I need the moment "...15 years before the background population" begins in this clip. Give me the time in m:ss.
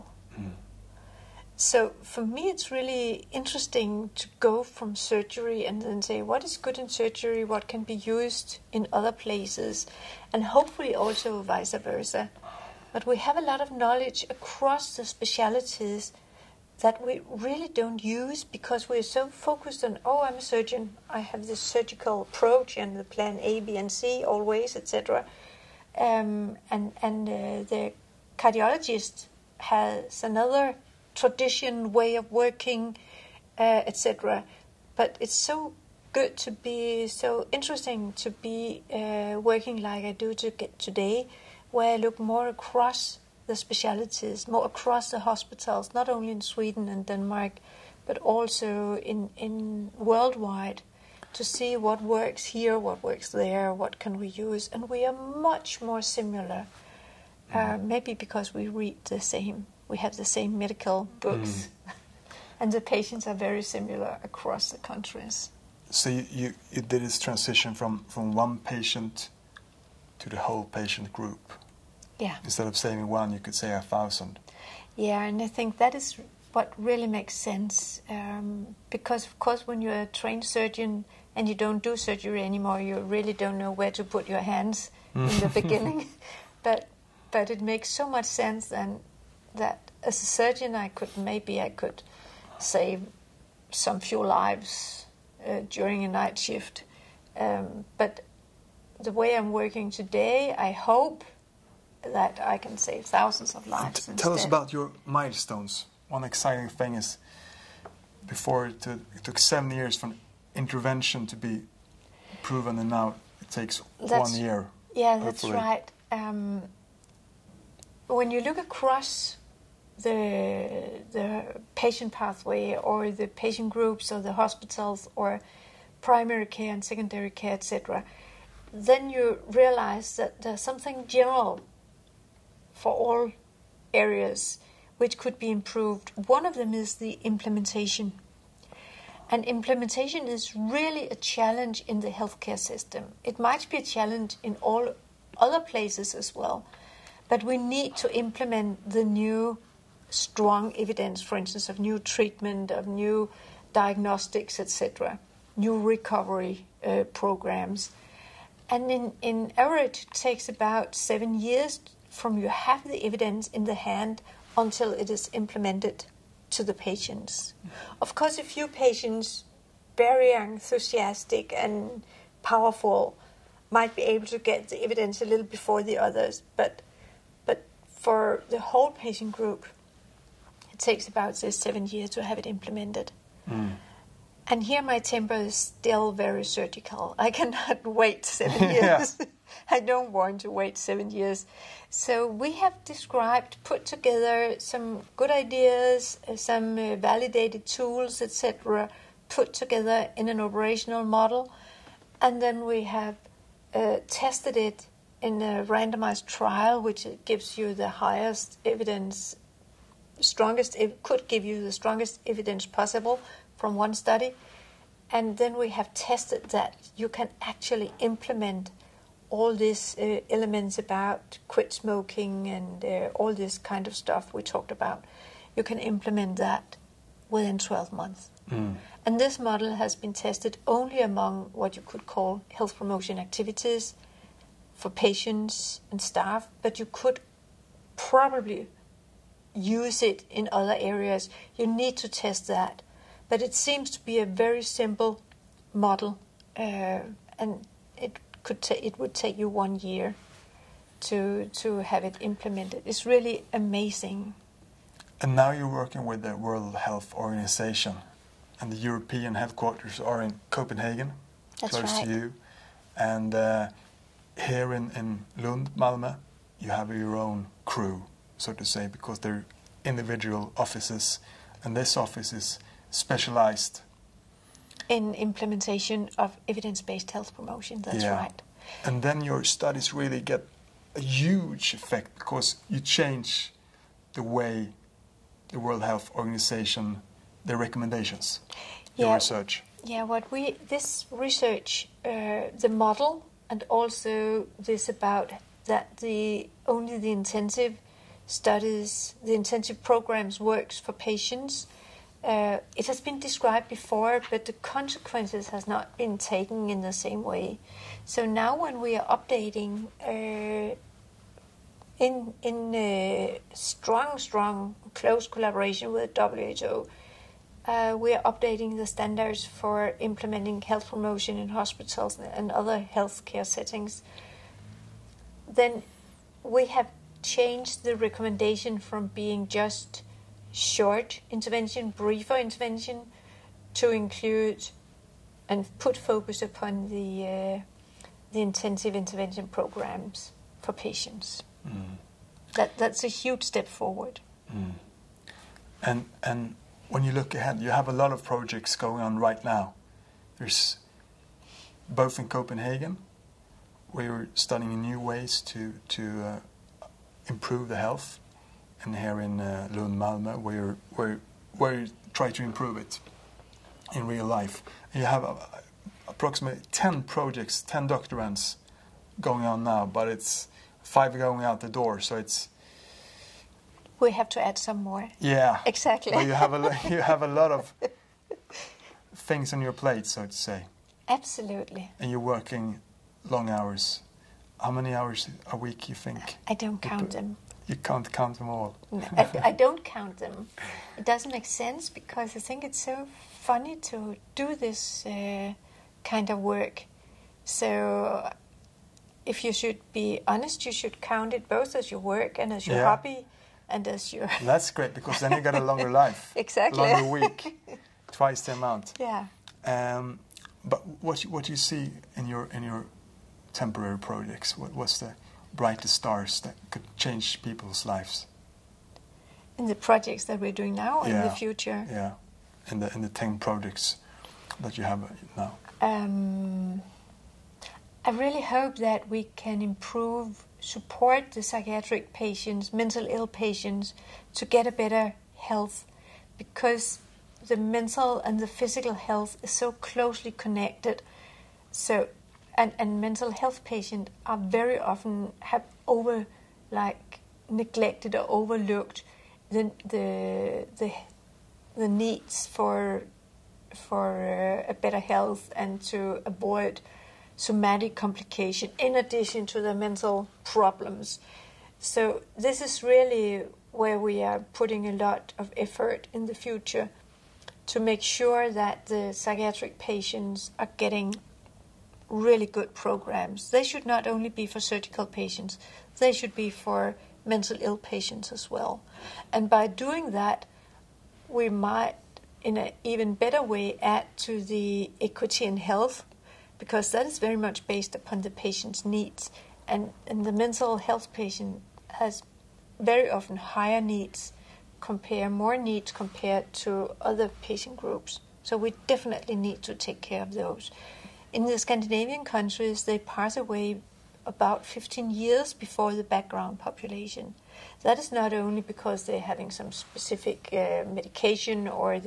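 8:24.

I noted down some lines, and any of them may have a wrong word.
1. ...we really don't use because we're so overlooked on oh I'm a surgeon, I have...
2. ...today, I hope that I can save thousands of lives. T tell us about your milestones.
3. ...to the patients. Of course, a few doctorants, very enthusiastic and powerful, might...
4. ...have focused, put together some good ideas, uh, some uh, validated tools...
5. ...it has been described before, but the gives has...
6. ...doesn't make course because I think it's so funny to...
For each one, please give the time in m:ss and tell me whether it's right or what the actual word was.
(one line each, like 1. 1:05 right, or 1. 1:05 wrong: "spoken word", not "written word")
1. 0:17 wrong: "focused", not "overlooked"
2. 1:39 right
3. 2:46 wrong: "patients", not "doctorants"
4. 3:12 wrong: "described", not "focused"
5. 5:02 wrong: "consequences", not "gives"
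6. 6:31 wrong: "sense", not "course".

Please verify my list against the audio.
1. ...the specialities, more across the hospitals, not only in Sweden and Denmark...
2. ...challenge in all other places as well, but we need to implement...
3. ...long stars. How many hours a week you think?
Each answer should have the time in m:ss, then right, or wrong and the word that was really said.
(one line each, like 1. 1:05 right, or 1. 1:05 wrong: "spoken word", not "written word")
1. 0:43 right
2. 2:23 right
3. 6:23 wrong: "hours", not "stars".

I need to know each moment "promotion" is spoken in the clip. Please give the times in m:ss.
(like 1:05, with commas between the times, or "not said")
3:52, 4:37, 5:20.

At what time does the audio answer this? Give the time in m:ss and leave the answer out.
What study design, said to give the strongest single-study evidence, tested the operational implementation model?
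3:25.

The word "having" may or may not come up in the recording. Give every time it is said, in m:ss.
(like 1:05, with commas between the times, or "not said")
8:29.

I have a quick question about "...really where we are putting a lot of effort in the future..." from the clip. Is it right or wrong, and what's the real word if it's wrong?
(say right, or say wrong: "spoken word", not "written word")
right.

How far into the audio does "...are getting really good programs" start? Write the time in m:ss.
7:50.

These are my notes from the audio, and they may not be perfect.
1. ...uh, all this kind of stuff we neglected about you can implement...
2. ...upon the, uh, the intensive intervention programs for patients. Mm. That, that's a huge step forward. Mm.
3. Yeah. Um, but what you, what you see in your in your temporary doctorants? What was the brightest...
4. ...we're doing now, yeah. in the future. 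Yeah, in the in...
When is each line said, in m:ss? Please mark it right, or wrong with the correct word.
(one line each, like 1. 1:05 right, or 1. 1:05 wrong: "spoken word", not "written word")
1. 3:42 wrong: "talked", not "neglected"
2. 5:36 right
3. 6:48 wrong: "projects", not "doctorants"
4. 7:00 right.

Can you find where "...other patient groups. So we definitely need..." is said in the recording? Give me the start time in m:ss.
8:17.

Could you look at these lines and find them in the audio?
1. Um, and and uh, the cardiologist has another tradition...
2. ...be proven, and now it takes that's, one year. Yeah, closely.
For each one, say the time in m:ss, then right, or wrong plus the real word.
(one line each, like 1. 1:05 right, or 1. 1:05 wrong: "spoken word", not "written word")
1. 0:25 right
2. 1:51 wrong: "hopefully", not "closely".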